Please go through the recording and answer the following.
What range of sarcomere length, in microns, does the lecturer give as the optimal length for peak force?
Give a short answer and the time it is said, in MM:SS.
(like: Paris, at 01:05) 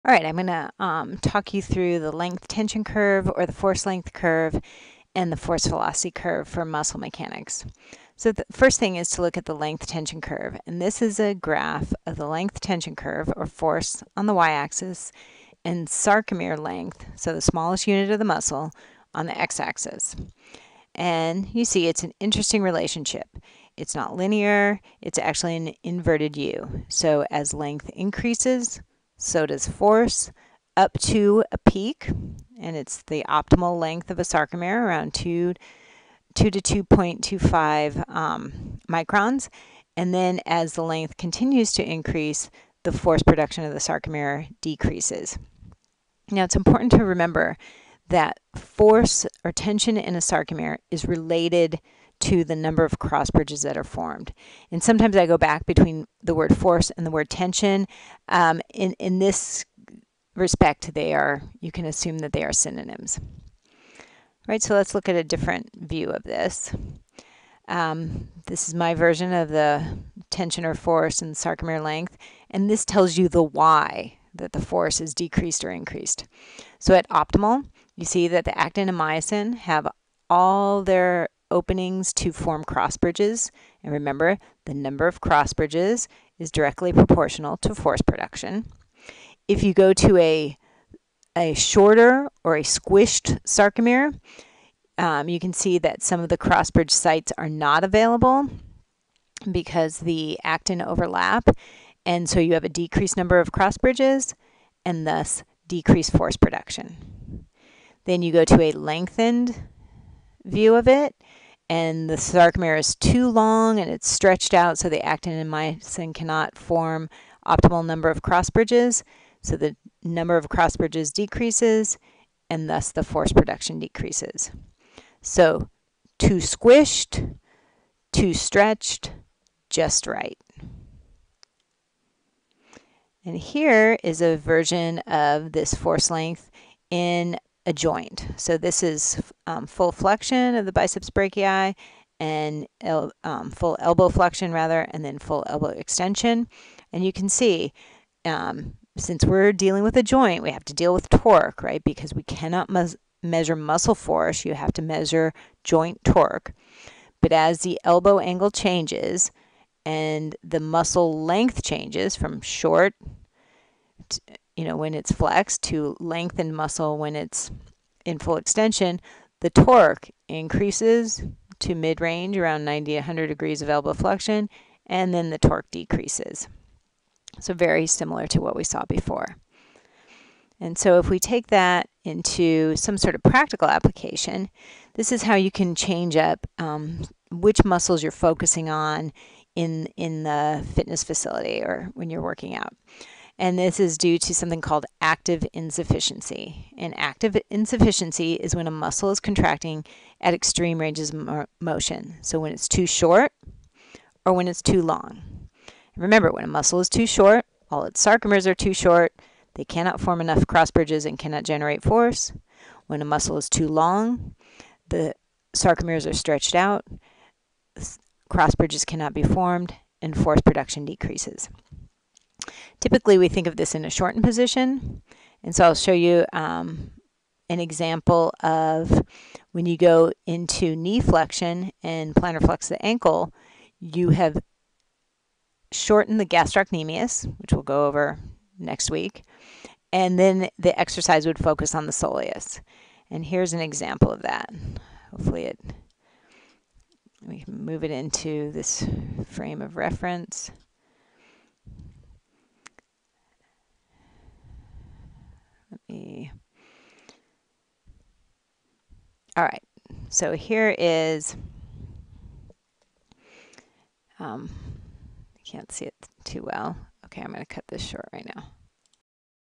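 2 to 2.25, at 00:36.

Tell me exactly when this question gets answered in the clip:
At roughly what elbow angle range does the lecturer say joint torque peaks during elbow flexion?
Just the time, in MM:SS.
02:52.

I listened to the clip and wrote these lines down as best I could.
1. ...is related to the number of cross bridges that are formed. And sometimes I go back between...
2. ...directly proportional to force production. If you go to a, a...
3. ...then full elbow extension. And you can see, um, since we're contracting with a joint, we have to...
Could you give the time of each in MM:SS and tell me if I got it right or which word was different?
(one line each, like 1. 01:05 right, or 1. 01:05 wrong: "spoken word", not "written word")
1. 00:50 right
2. 01:26 right
3. 02:25 wrong: "dealing", not "contracting".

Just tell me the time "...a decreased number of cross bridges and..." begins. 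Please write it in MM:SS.
01:42.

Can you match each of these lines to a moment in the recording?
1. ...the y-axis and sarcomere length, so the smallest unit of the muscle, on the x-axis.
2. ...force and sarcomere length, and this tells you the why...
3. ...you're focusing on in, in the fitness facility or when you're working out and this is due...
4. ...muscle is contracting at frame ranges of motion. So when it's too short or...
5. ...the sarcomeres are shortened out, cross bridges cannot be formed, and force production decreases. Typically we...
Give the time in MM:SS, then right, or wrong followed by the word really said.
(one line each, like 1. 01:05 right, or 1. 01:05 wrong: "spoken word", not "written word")
1. 00:14 right
2. 01:10 right
3. 03:08 right
4. 03:18 wrong: "extreme", not "frame"
5. 03:34 wrong: "stretched", not "shortened".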